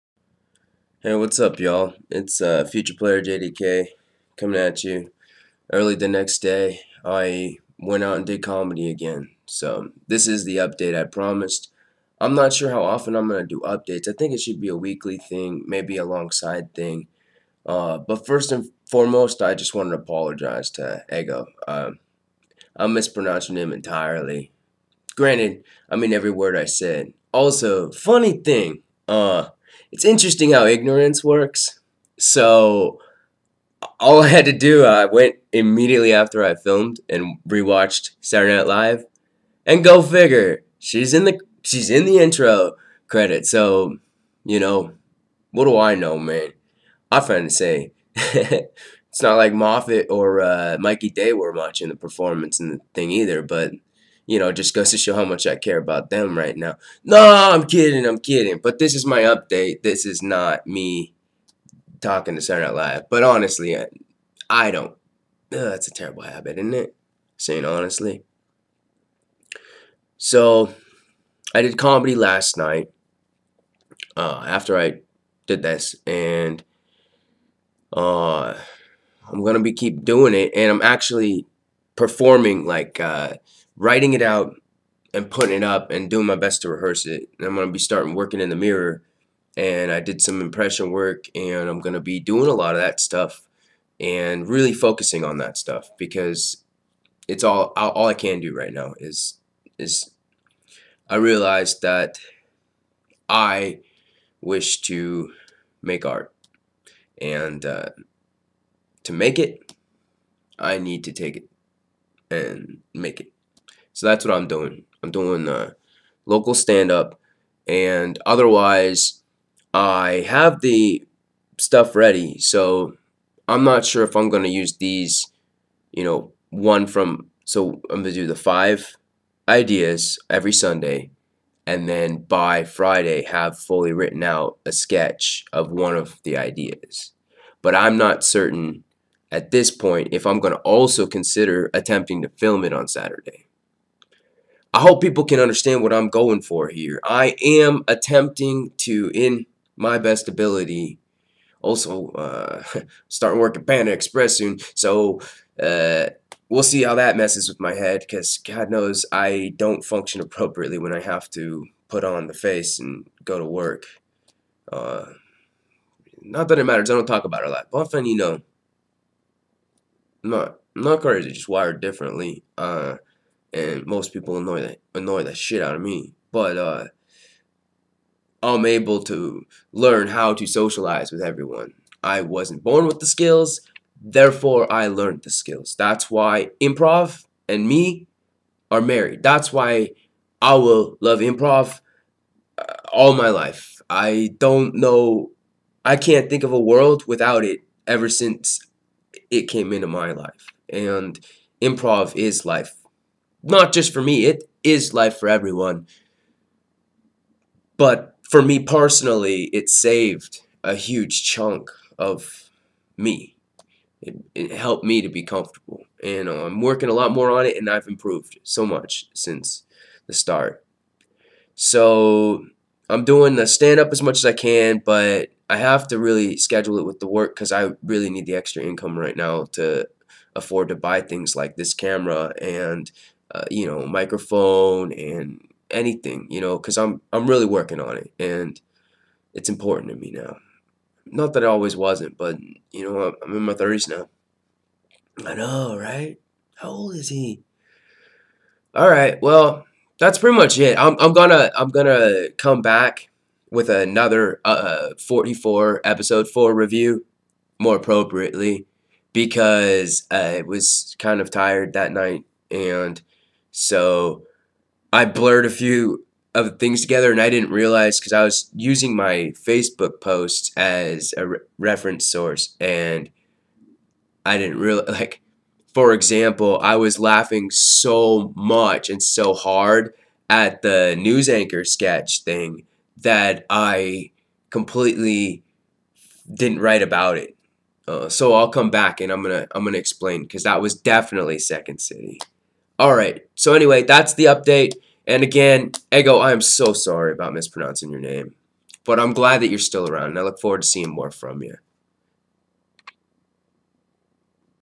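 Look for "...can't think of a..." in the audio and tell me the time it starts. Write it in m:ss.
3:15.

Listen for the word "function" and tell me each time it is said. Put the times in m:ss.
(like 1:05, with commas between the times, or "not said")
2:39.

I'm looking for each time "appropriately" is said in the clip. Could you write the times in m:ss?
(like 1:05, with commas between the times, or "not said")
2:40, 4:17.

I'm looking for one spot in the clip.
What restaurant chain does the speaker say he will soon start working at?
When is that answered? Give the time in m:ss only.
2:33.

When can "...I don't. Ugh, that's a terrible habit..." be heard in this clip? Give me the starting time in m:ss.
1:04.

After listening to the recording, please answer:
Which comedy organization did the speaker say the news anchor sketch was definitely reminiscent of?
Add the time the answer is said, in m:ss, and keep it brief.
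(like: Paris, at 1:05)
Second City, at 4:51.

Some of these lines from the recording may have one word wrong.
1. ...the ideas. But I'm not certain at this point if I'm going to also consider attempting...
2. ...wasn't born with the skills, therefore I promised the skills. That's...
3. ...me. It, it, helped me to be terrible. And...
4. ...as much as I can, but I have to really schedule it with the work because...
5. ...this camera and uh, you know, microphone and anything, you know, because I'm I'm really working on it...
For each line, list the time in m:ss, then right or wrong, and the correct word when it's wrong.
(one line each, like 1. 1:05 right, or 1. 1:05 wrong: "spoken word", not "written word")
1. 2:16 right
2. 3:02 wrong: "learned", not "promised"
3. 3:32 wrong: "comfortable", not "terrible"
4. 3:43 right
5. 3:51 right.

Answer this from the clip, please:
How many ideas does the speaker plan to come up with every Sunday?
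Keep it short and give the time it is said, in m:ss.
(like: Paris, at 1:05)
5, at 2:08.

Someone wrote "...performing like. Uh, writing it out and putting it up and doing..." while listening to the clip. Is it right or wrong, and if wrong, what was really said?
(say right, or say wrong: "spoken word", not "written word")
right.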